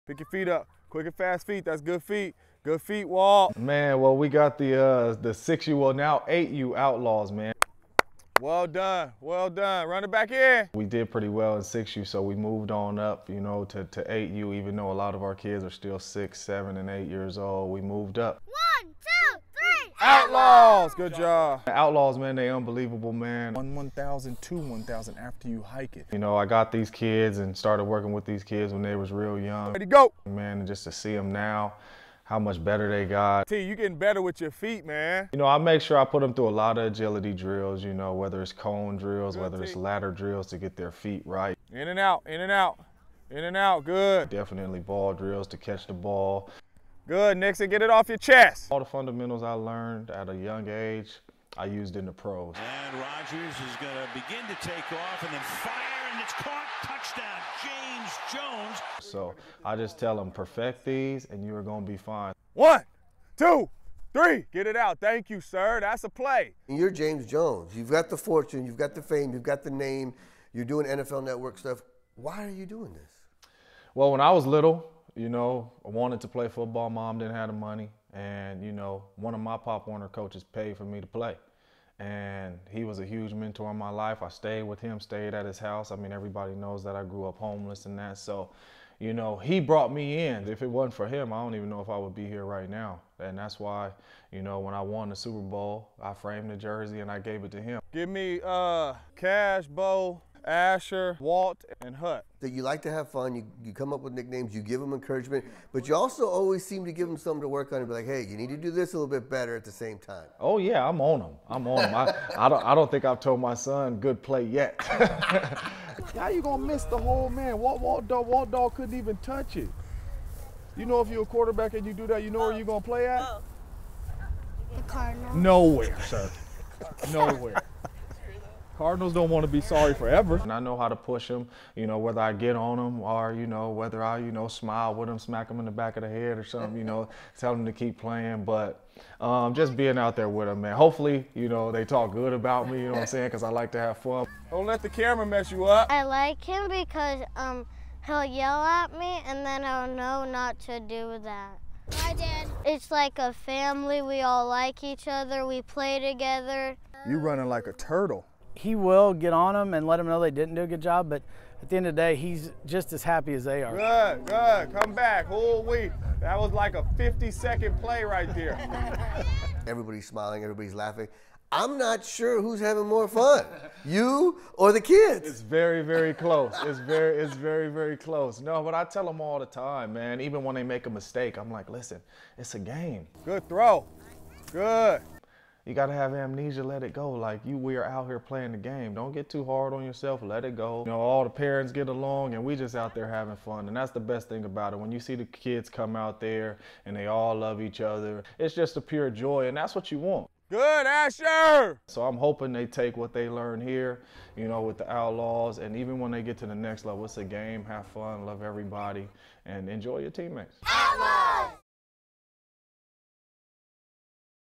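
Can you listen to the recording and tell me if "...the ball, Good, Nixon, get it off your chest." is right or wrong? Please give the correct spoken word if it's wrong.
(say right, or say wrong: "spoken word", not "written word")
right.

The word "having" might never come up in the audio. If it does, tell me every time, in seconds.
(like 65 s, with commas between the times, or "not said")
172 s, 193 s.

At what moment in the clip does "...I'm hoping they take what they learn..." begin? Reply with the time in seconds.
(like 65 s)
202 s.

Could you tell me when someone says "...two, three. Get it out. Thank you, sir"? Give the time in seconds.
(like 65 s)
63 s.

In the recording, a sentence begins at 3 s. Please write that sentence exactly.
Man, well, we got the uh, the six you well now eight you outlaws, man.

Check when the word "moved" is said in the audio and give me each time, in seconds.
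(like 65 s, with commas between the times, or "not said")
12 s, 17 s.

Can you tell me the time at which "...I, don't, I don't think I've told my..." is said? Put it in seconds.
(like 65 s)
112 s.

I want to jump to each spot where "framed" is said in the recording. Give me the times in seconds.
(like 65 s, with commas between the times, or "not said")
96 s.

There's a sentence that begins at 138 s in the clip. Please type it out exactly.
But um, just being out there with them, man.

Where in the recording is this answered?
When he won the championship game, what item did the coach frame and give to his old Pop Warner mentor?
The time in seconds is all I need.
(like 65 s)
96 s.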